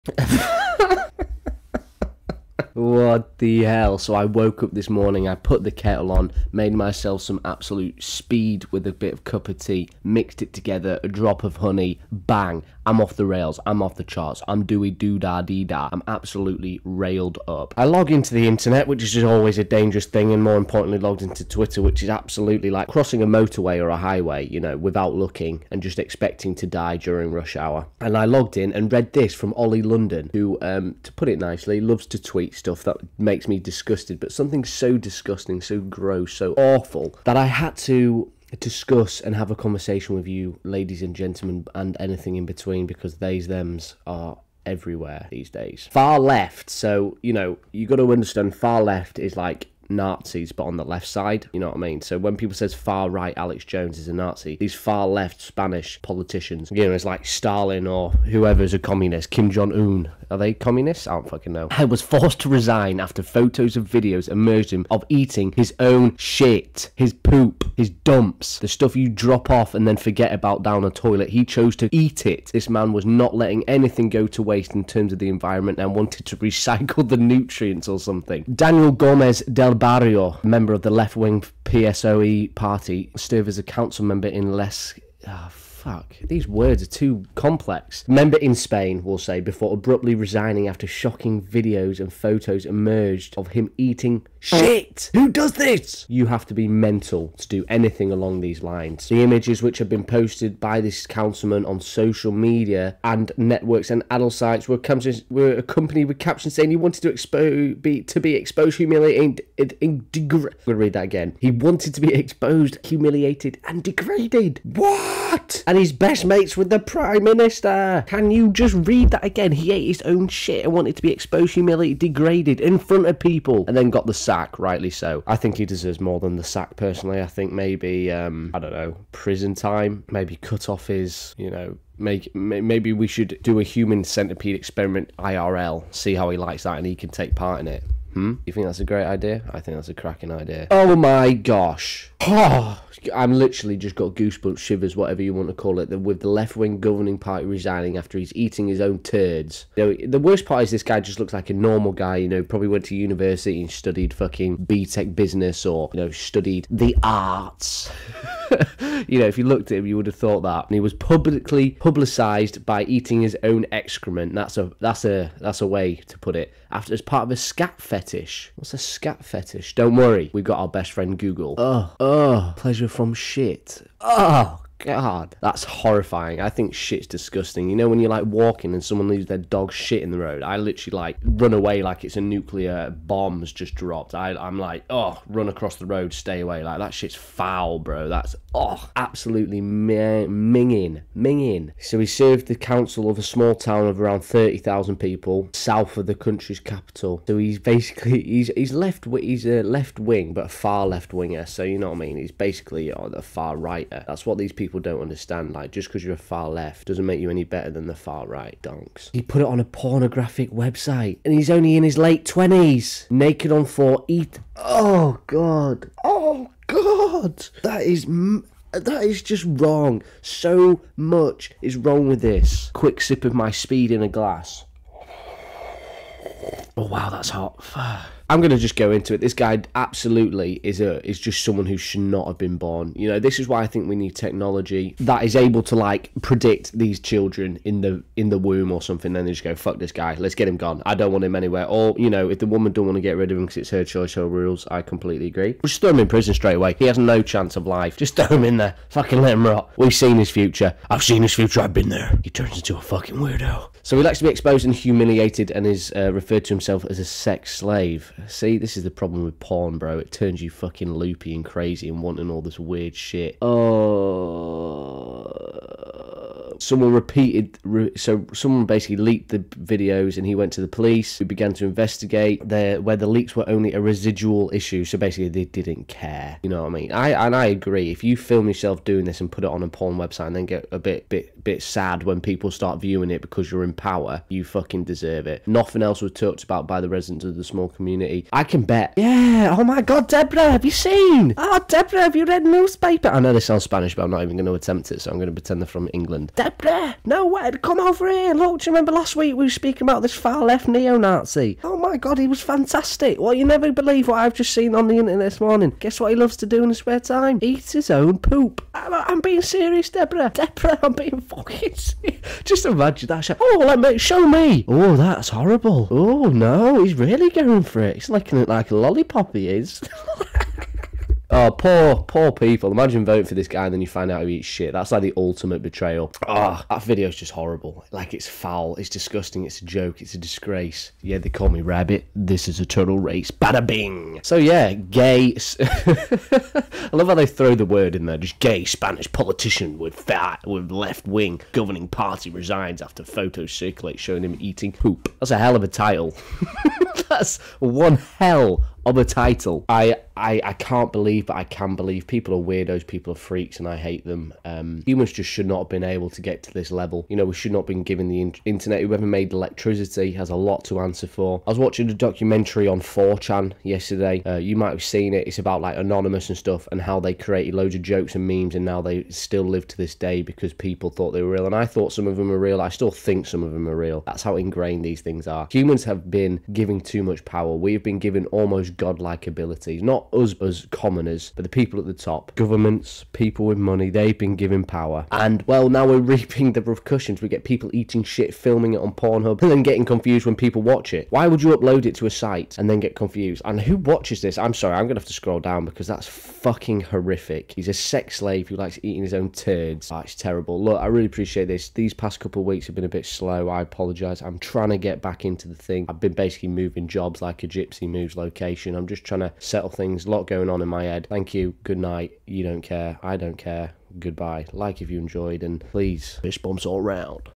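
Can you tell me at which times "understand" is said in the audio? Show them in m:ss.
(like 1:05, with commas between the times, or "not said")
0:48, 3:25.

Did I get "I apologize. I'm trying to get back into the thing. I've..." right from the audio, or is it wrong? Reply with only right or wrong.
right.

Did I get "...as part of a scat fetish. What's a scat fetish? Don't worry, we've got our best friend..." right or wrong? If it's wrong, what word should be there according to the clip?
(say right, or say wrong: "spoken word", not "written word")
right.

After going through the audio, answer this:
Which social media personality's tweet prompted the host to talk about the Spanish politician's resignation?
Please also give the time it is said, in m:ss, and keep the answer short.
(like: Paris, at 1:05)
Ollie London, at 0:29.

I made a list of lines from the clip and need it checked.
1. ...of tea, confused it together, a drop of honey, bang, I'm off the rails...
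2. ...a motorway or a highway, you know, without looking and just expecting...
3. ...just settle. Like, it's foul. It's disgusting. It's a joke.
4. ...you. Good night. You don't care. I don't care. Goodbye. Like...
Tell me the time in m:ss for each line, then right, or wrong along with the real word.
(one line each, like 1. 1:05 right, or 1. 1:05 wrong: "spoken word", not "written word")
1. 0:09 wrong: "mixed", not "confused"
2. 0:23 right
3. 5:27 wrong: "horrible", not "settle"
4. 6:51 right.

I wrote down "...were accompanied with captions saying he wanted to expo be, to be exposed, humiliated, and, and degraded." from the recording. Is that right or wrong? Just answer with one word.
right.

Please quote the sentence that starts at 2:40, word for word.
And he was publicly publicised by eating his own excrement.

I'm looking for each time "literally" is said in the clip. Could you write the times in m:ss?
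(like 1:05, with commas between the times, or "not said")
2:23, 3:00.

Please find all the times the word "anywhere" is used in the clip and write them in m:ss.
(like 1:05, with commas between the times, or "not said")
4:01.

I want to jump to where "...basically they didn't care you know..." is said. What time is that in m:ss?
4:34.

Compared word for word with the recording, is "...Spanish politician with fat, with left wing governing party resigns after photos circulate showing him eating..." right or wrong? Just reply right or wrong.
right.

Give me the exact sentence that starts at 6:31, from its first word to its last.
Why would you upload it to a site and then get confused?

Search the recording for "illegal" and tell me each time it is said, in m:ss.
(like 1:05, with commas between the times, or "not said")
not said.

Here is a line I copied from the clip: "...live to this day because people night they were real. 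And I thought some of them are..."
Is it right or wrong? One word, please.
wrong.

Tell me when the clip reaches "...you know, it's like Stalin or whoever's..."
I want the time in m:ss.
0:56.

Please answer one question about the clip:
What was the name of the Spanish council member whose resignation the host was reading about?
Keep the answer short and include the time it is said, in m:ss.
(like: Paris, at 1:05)
Daniel Gomez del Barrio, at 1:18.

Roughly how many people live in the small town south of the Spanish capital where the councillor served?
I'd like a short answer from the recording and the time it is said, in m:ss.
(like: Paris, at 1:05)
30,000, at 3:14.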